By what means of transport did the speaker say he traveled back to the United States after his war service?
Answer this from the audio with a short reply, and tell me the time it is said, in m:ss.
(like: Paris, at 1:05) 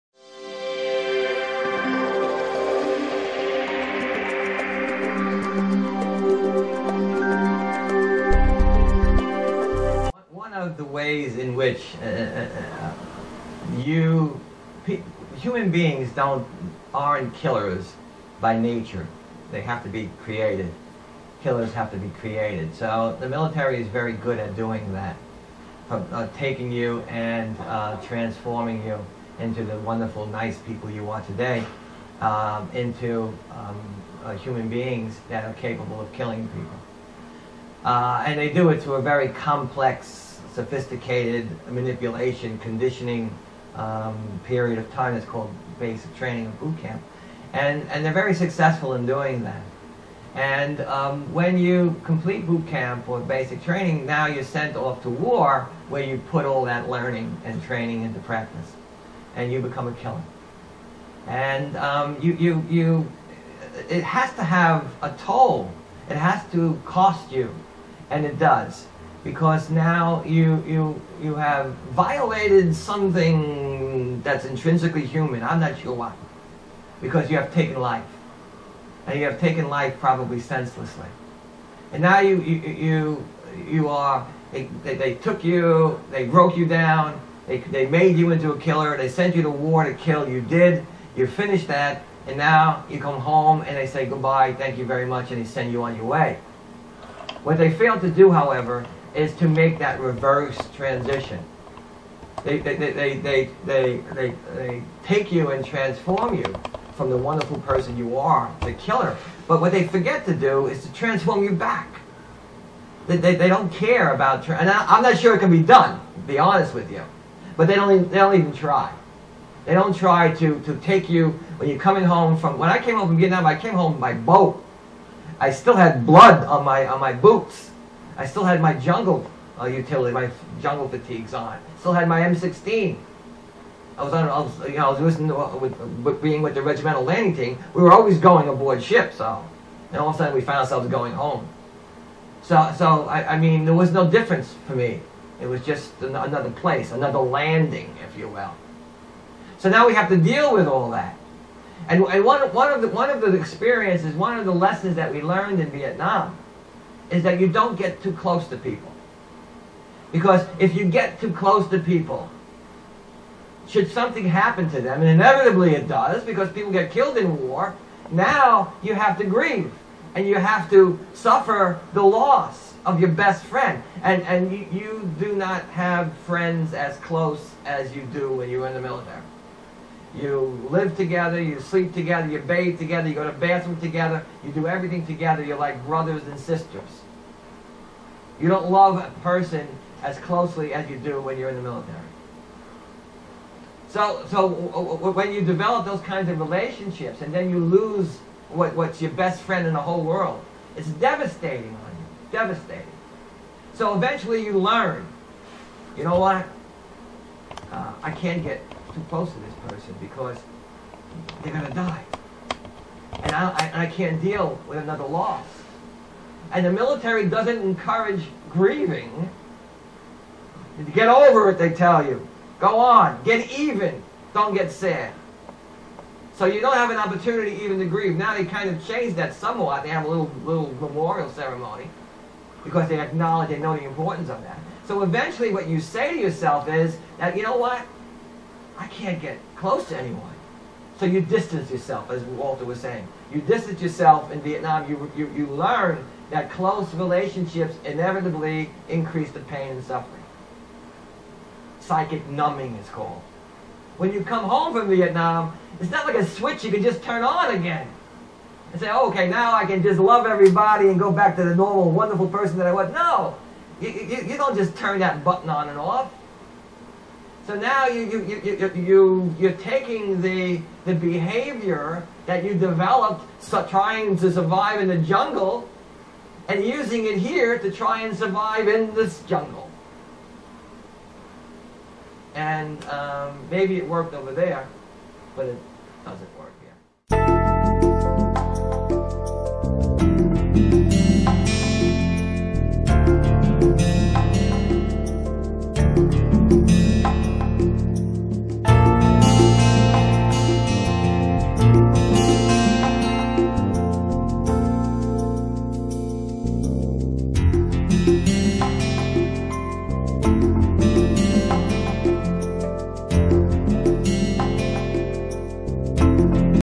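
by boat, at 2:03.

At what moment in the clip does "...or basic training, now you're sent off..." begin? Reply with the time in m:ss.
0:53.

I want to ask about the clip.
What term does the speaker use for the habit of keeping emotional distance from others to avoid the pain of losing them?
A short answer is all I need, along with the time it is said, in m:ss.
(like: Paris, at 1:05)
Psychic numbing, at 4:11.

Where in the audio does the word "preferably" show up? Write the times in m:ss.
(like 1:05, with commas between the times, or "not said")
not said.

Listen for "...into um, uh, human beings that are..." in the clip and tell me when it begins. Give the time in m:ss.
0:32.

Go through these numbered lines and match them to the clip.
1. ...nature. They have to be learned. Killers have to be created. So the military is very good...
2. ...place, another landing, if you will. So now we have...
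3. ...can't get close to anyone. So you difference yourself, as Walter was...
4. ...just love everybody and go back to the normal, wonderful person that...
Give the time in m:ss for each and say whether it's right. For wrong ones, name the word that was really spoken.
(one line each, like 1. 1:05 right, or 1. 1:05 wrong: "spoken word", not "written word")
1. 0:18 wrong: "created", not "learned"
2. 2:26 right
3. 3:58 wrong: "distance", not "difference"
4. 4:19 right.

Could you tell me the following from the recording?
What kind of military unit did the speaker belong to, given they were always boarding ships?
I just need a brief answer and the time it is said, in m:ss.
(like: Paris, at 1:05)
regimental landing team, at 2:16.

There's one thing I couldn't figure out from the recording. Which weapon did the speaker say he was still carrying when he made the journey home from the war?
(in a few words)
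M16.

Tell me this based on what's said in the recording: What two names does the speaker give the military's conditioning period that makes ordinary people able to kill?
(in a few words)
basic training and boot camp.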